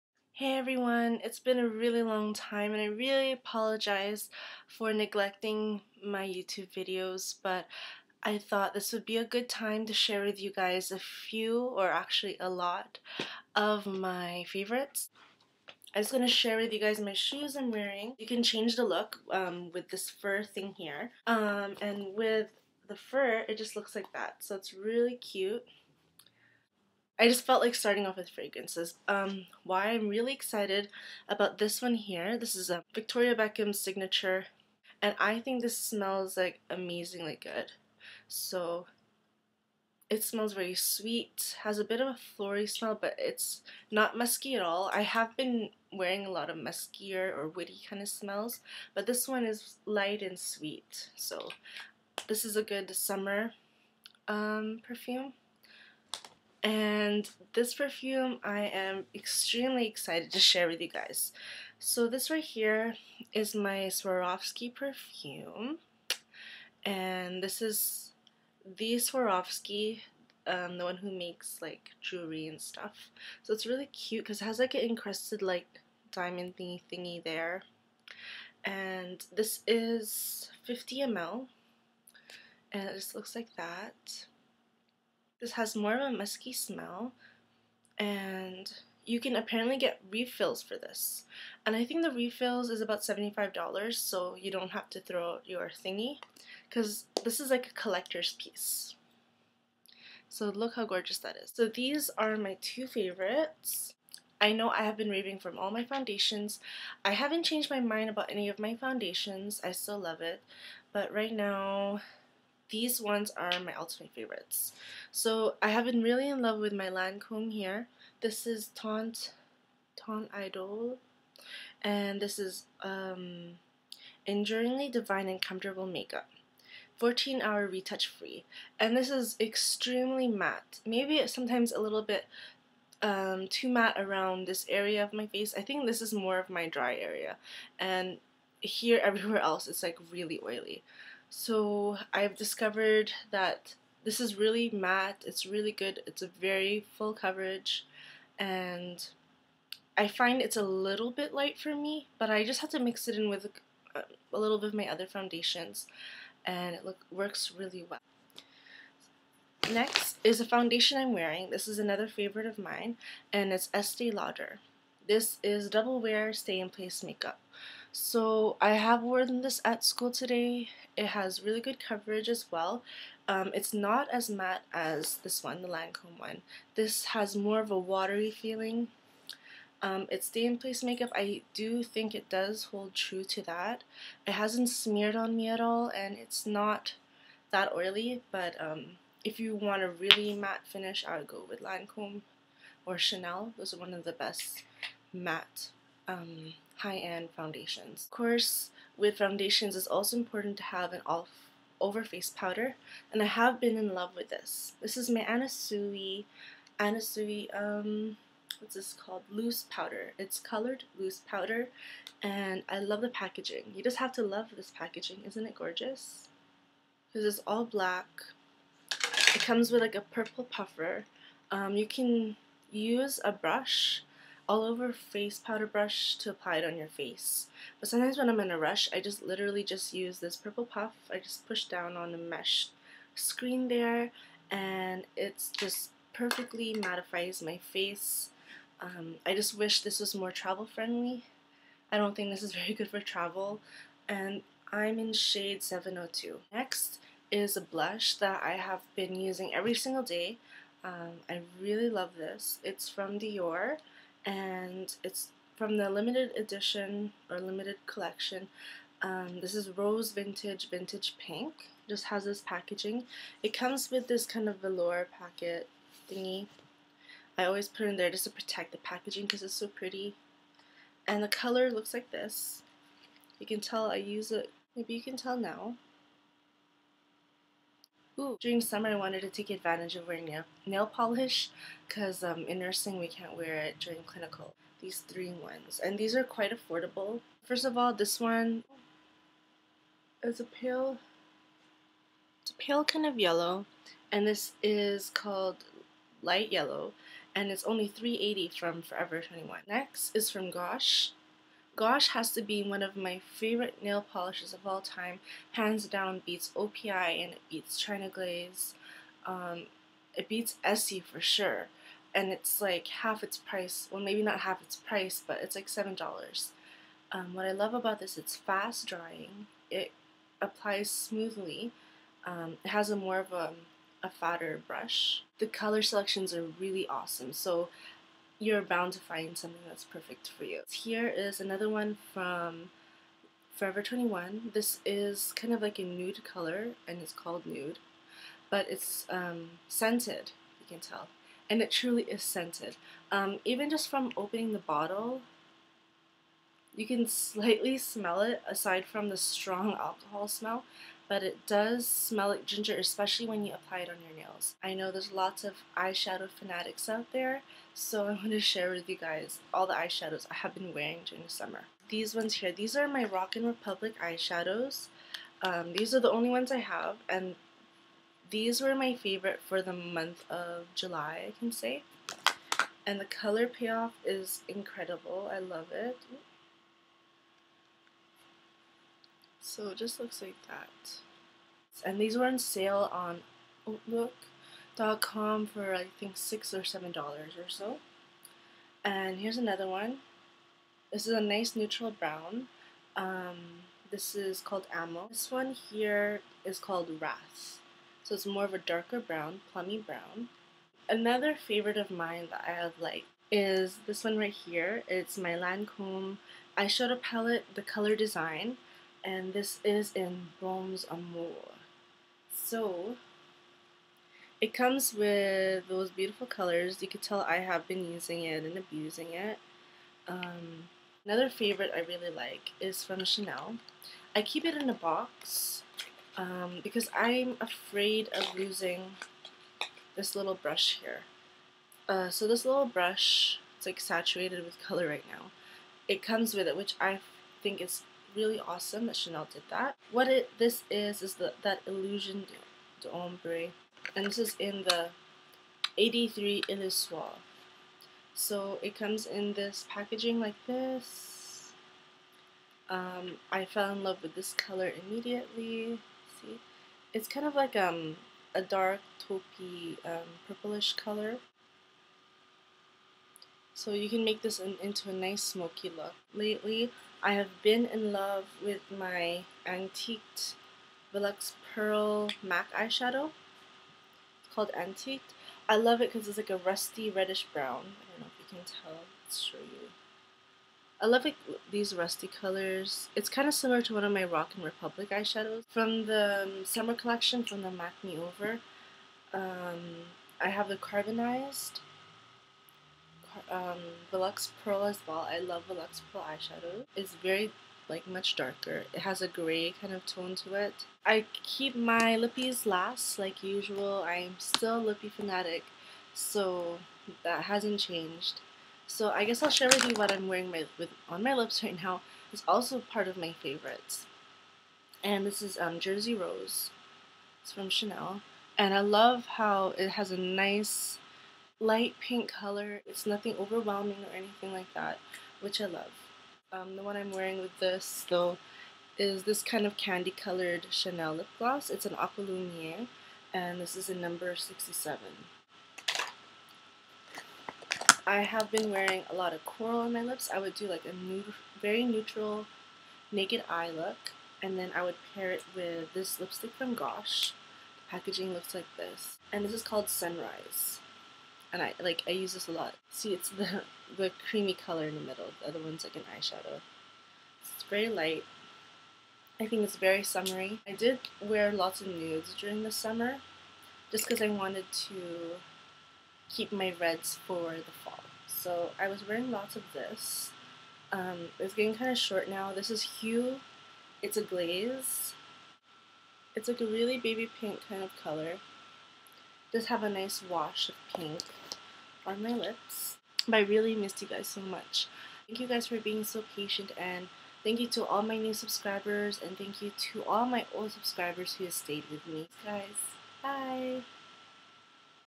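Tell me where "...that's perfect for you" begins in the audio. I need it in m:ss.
5:29.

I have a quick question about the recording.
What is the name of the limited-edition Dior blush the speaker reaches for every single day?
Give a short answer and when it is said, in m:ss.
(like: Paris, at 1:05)
Rose Vintage, at 4:19.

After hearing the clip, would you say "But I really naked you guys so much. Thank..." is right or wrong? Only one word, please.
wrong.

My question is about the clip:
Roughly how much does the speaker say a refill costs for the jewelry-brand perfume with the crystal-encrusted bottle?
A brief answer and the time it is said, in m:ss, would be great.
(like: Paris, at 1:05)
$75, at 1:33.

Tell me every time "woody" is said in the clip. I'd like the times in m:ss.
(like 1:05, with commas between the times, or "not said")
0:47.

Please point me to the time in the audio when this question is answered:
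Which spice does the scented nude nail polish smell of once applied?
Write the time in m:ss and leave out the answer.
5:52.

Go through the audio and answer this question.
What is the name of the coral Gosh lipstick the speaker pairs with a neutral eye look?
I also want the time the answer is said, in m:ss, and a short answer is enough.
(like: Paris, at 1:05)
Sunrise, at 9:09.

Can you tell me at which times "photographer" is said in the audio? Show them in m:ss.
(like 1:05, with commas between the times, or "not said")
not said.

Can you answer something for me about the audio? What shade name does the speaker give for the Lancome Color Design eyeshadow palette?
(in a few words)
Bronze Amour.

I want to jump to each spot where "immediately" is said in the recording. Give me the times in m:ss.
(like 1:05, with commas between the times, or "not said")
7:34.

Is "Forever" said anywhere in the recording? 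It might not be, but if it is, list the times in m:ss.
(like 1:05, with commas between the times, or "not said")
4:58, 5:33.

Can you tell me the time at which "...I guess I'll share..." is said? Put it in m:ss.
8:28.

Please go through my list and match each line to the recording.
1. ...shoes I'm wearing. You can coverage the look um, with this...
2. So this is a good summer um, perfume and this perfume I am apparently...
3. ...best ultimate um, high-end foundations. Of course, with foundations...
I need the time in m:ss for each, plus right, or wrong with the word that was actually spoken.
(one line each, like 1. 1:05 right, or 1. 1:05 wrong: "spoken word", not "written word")
1. 0:17 wrong: "change", not "coverage"
2. 0:51 wrong: "extremely", not "apparently"
3. 3:14 wrong: "matte", not "ultimate".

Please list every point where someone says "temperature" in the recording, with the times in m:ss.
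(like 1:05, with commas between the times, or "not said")
not said.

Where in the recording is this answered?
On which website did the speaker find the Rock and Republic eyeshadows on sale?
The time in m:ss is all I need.
6:23.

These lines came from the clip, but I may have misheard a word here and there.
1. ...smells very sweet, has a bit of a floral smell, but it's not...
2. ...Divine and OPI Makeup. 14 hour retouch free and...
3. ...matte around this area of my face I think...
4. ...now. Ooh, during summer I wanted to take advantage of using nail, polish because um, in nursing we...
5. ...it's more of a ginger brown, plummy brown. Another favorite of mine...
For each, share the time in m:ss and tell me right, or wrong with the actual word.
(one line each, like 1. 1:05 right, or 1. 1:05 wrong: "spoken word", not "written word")
1. 0:40 right
2. 2:04 wrong: "Comfortable", not "OPI"
3. 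2:13 right
4. 4:35 wrong: "wearing", not "using"
5. 6:38 wrong: "darker", not "ginger".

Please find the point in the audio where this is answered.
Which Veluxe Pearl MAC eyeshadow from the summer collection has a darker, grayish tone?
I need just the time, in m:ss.
8:10.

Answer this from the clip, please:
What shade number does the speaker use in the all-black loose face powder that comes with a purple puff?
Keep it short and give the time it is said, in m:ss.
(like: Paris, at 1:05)
702, at 4:05.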